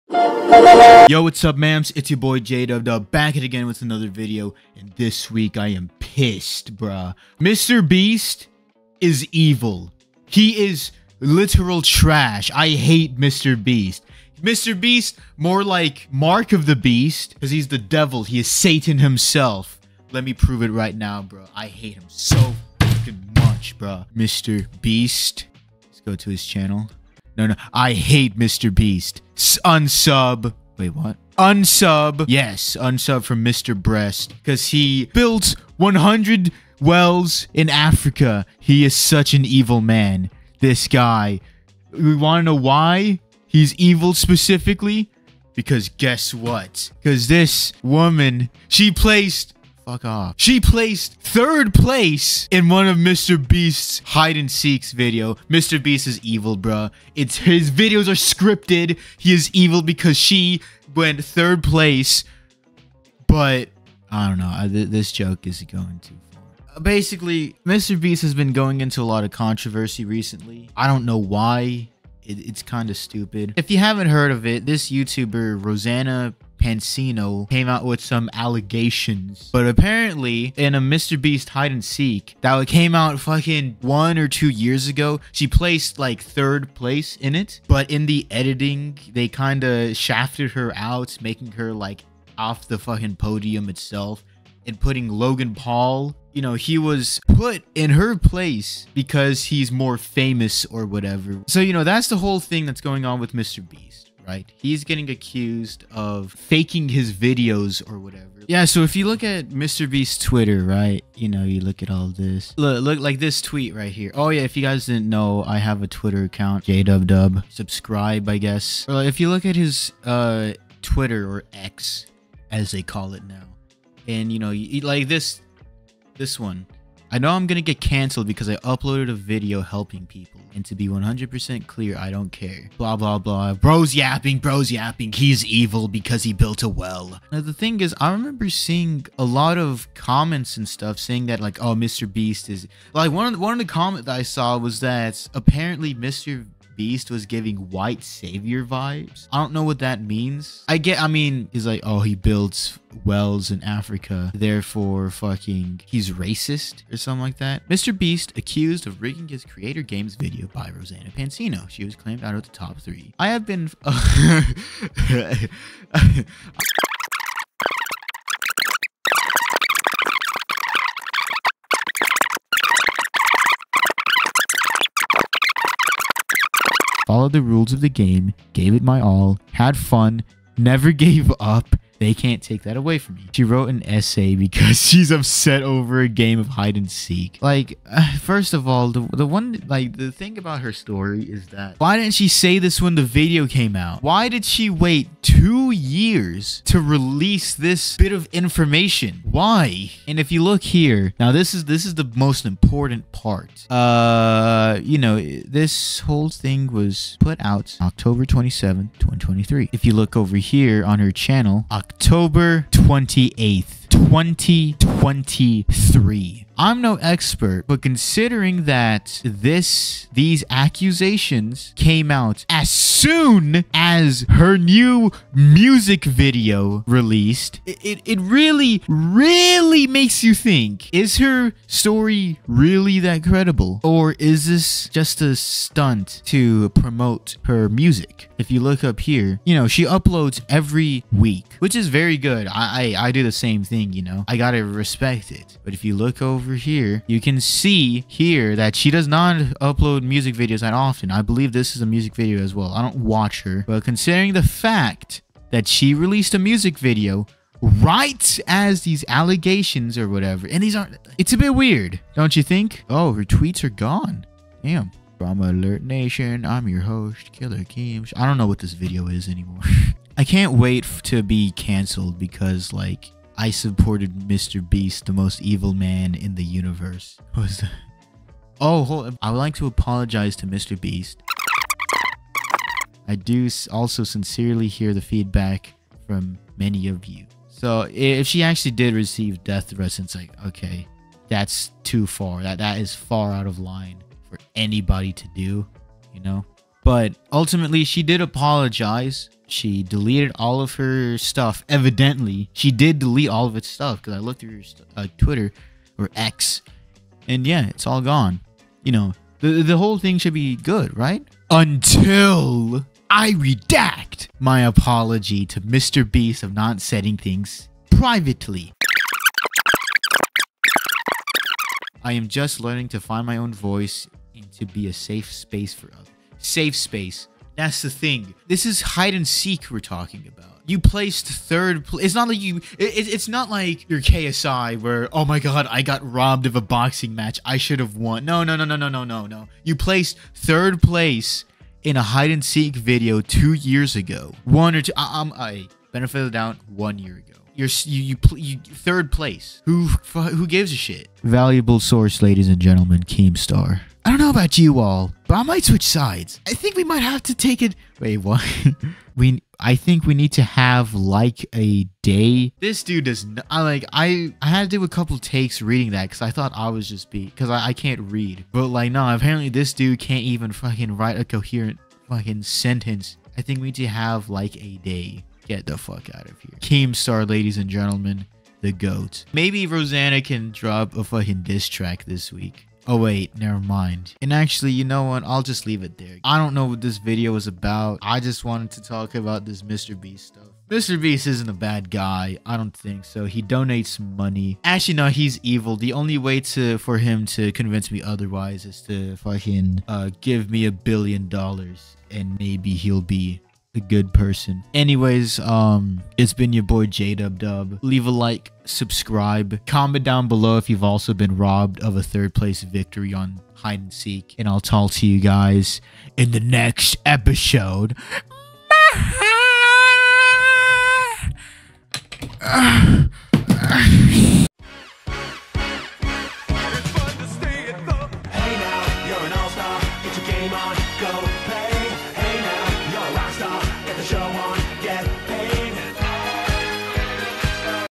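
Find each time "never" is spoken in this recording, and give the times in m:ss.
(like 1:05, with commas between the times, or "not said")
3:00, 6:23.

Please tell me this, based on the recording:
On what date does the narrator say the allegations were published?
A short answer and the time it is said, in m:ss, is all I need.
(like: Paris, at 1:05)
October 27, 2023, at 3:27.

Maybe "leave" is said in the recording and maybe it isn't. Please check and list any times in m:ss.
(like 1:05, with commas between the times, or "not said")
6:25, 6:47.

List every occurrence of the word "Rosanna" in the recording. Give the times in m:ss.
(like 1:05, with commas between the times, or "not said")
1:15, 2:40, 6:19.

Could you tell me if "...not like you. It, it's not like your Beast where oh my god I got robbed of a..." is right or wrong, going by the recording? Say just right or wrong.
wrong.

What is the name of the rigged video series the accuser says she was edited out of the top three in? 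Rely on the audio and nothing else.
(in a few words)
Creator Games.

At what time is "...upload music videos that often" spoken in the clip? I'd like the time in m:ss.
4:09.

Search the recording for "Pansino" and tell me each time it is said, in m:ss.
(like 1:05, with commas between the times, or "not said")
1:16, 2:41.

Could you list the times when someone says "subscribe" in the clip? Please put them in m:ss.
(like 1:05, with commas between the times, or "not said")
1:57, 6:48.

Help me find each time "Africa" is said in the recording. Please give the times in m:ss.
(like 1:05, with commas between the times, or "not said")
0:37, 2:33.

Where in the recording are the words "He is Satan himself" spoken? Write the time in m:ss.
0:18.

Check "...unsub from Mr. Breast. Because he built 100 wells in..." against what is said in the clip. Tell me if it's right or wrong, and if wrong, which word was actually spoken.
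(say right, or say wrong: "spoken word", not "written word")
right.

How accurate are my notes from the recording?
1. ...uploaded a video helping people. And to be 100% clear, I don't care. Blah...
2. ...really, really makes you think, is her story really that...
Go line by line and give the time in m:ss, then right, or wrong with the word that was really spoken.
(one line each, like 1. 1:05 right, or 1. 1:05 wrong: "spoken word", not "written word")
1. 2:08 right
2. 3:48 right.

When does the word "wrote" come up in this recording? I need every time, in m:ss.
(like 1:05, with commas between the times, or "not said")
3:03.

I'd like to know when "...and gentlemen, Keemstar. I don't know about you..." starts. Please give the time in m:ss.
5:52.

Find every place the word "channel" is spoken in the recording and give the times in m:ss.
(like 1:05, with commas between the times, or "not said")
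0:26, 3:31.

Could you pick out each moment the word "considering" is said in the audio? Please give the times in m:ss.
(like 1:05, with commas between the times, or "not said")
3:37, 4:13.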